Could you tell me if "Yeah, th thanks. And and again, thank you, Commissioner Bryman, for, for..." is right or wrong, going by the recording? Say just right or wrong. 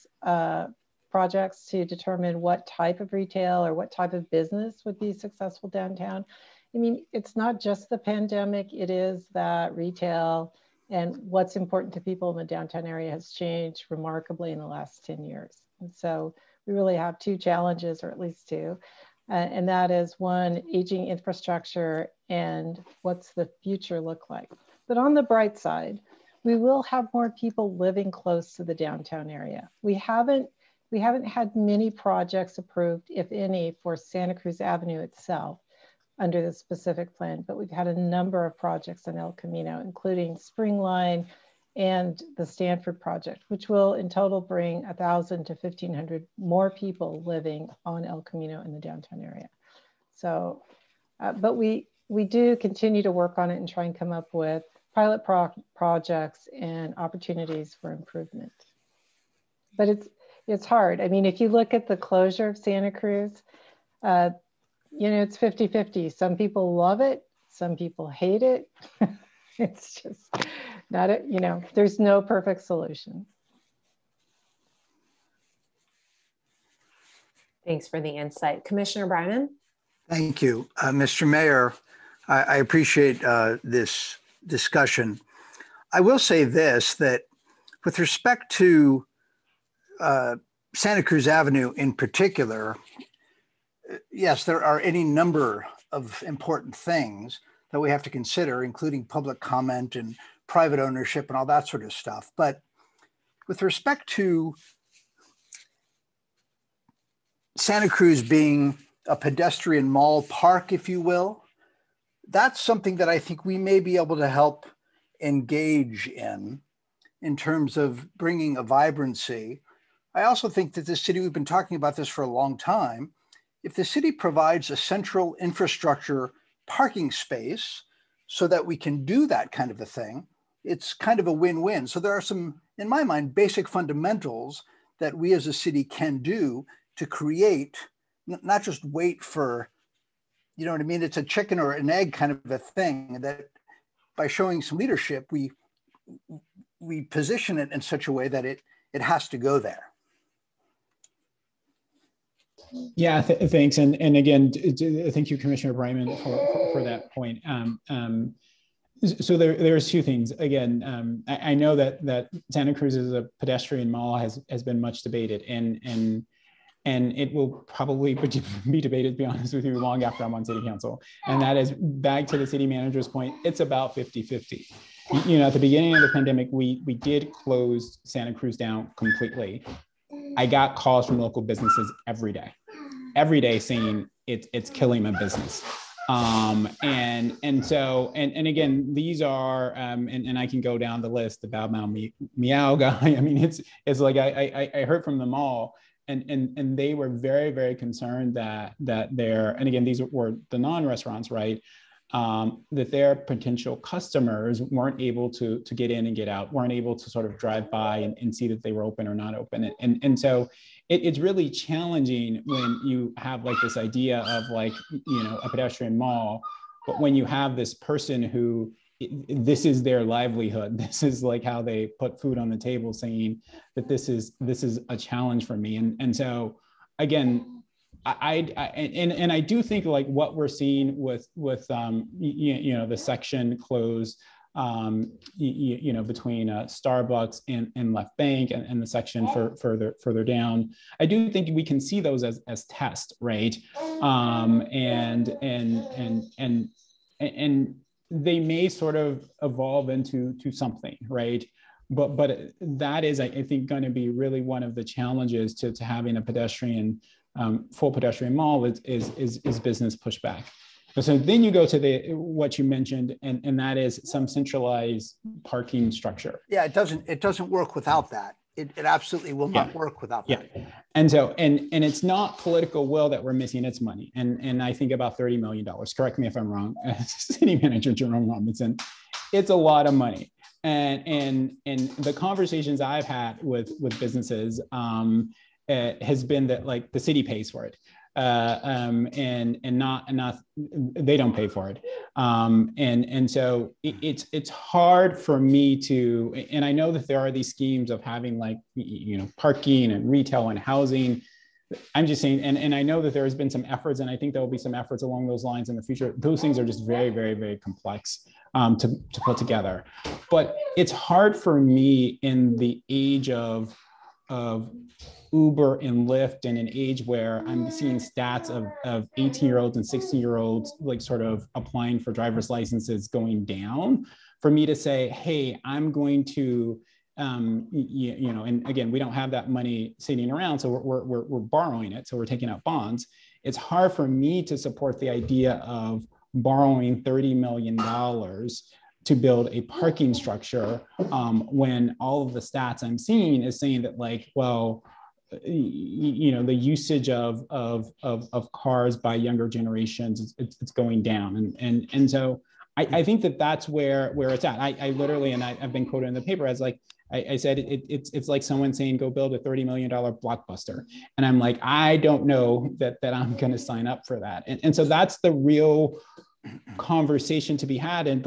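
right.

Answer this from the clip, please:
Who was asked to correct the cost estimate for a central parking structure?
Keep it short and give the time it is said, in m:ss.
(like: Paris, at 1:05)
Jerome Robinson, at 4:37.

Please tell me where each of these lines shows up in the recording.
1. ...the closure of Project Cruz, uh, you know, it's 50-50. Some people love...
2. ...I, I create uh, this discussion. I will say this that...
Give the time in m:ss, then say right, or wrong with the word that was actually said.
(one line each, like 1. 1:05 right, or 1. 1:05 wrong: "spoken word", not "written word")
1. 1:01 wrong: "Santa", not "Project"
2. 1:22 wrong: "appreciate", not "create".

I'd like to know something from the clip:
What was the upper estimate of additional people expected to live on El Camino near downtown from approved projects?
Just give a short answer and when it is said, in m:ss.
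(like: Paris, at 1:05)
1,500, at 0:45.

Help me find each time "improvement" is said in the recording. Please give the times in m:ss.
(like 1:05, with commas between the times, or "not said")
0:57.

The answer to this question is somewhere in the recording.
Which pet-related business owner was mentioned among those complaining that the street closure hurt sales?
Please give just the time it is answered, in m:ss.
3:11.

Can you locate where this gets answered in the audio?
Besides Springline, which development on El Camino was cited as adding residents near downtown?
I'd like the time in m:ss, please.
0:42.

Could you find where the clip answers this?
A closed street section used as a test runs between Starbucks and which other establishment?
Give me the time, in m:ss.
3:57.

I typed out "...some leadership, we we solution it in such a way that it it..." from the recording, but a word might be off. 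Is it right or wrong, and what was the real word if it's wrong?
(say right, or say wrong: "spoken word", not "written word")
wrong: "position", not "solution".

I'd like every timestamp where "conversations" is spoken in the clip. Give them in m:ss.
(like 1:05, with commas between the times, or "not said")
4:42, 6:06.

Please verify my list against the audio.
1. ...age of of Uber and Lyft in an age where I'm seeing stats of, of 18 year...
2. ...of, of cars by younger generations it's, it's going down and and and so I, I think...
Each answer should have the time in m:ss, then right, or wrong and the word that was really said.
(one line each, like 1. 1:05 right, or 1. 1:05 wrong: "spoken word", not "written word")
1. 5:12 right
2. 5:48 right.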